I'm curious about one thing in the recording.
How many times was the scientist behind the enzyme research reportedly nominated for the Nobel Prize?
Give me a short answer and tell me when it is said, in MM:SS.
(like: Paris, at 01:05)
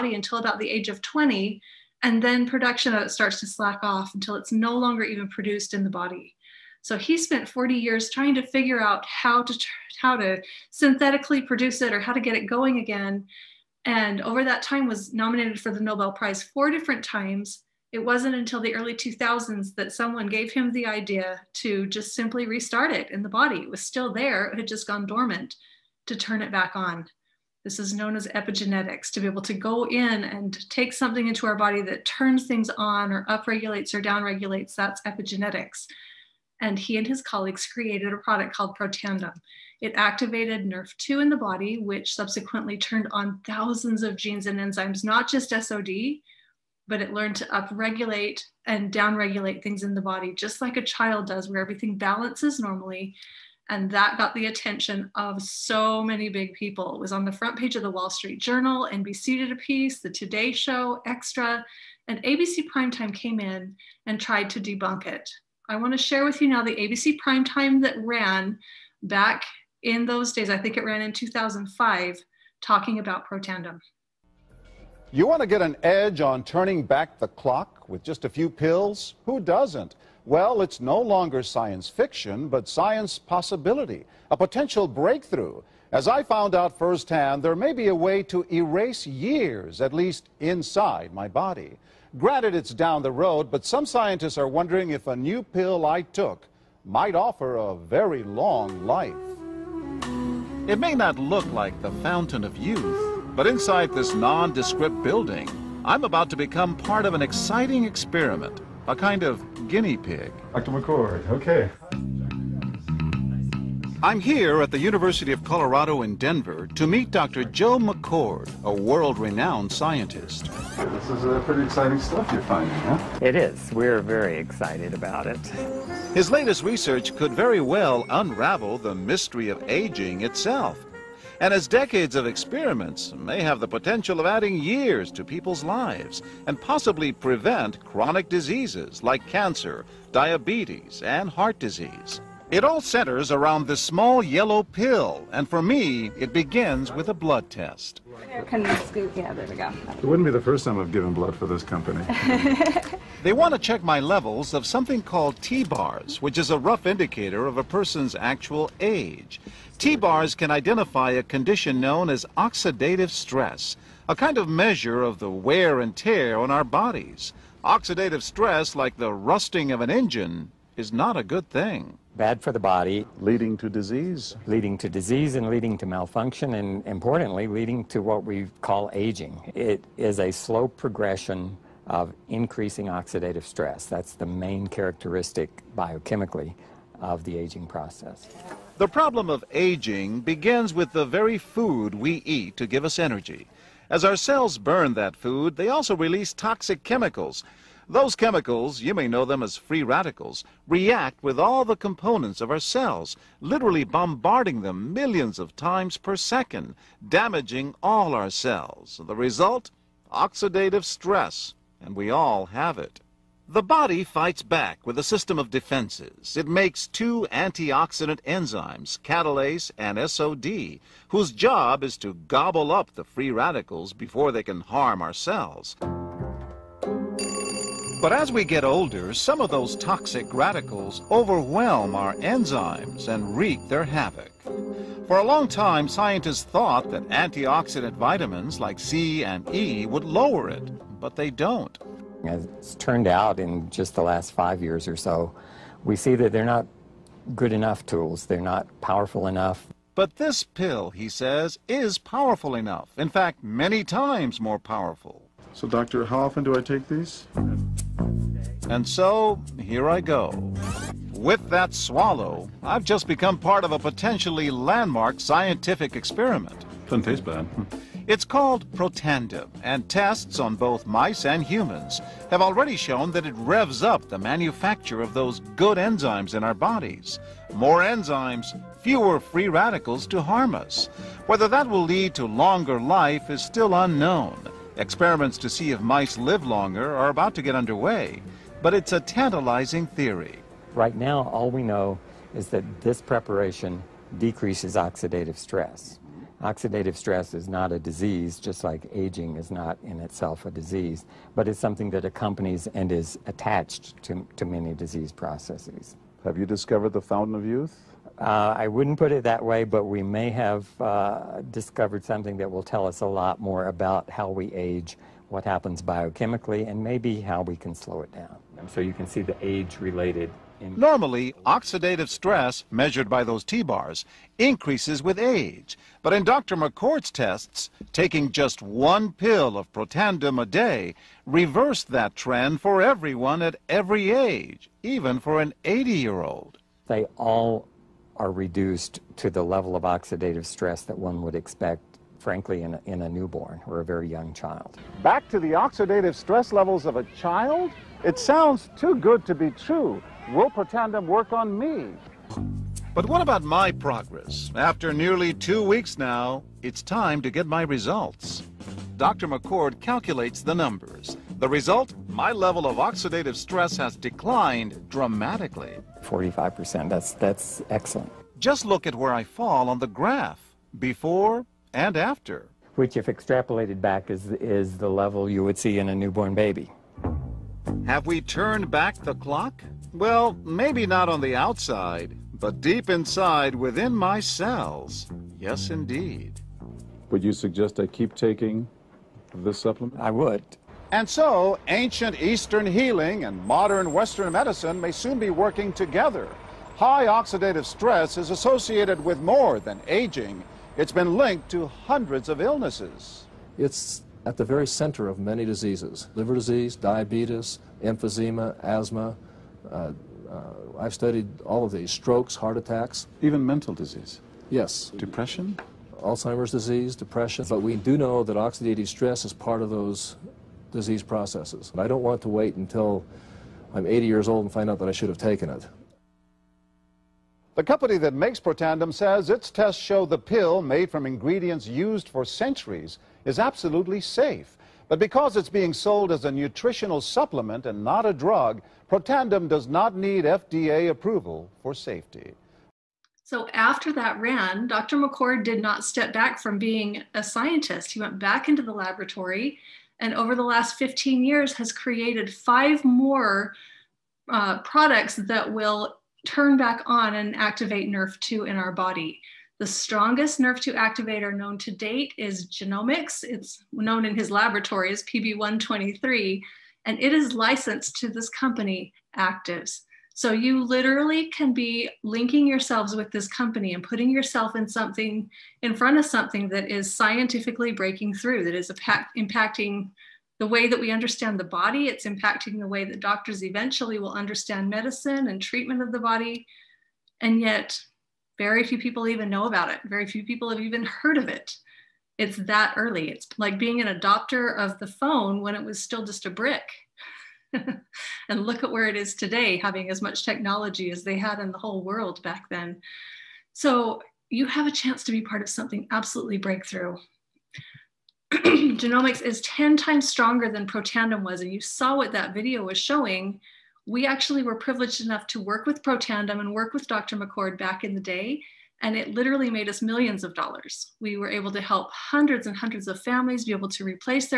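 4, at 00:16.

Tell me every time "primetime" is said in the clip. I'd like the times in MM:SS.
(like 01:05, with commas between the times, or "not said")
01:02, 01:07.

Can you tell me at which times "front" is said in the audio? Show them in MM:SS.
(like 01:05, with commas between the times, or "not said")
00:57, 07:55.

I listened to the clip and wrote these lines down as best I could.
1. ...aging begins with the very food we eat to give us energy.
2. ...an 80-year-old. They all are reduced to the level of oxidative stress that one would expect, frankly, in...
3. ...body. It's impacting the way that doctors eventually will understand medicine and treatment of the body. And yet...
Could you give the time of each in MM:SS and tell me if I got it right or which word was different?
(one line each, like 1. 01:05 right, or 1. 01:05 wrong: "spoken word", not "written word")
1. 03:09 right
2. 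05:35 right
3. 08:01 right.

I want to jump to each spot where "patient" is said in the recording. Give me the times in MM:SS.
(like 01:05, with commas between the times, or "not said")
not said.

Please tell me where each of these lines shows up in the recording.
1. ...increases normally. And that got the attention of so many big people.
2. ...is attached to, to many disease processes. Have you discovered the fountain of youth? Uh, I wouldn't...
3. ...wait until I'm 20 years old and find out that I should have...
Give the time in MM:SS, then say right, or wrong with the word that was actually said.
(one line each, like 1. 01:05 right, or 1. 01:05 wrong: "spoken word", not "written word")
1. 00:51 wrong: "balances", not "increases"
2. 05:02 right
3. 07:02 wrong: "80", not "20".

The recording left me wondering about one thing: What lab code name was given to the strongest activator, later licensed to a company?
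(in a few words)
PB123.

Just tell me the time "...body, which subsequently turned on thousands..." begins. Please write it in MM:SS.
00:41.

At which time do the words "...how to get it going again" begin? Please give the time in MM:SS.
00:12.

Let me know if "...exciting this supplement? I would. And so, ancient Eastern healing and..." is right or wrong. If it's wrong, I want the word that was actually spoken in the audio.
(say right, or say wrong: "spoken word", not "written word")
wrong: "taking", not "exciting".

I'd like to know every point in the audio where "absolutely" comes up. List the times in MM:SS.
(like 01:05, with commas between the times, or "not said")
07:13, 08:25.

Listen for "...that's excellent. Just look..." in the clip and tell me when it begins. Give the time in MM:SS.
06:07.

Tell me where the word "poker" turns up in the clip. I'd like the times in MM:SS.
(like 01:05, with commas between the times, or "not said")
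not said.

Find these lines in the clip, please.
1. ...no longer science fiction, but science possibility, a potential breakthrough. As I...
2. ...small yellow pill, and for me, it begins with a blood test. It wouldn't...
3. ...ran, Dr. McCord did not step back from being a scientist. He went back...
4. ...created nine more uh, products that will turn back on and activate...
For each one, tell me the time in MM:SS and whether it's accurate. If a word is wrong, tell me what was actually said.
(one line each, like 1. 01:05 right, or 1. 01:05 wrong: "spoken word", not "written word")
1. 01:20 right
2. 02:23 right
3. 07:24 right
4. 07:31 wrong: "five", not "nine".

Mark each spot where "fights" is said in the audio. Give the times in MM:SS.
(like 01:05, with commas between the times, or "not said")
03:34.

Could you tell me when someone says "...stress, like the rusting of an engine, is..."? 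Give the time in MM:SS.
02:48.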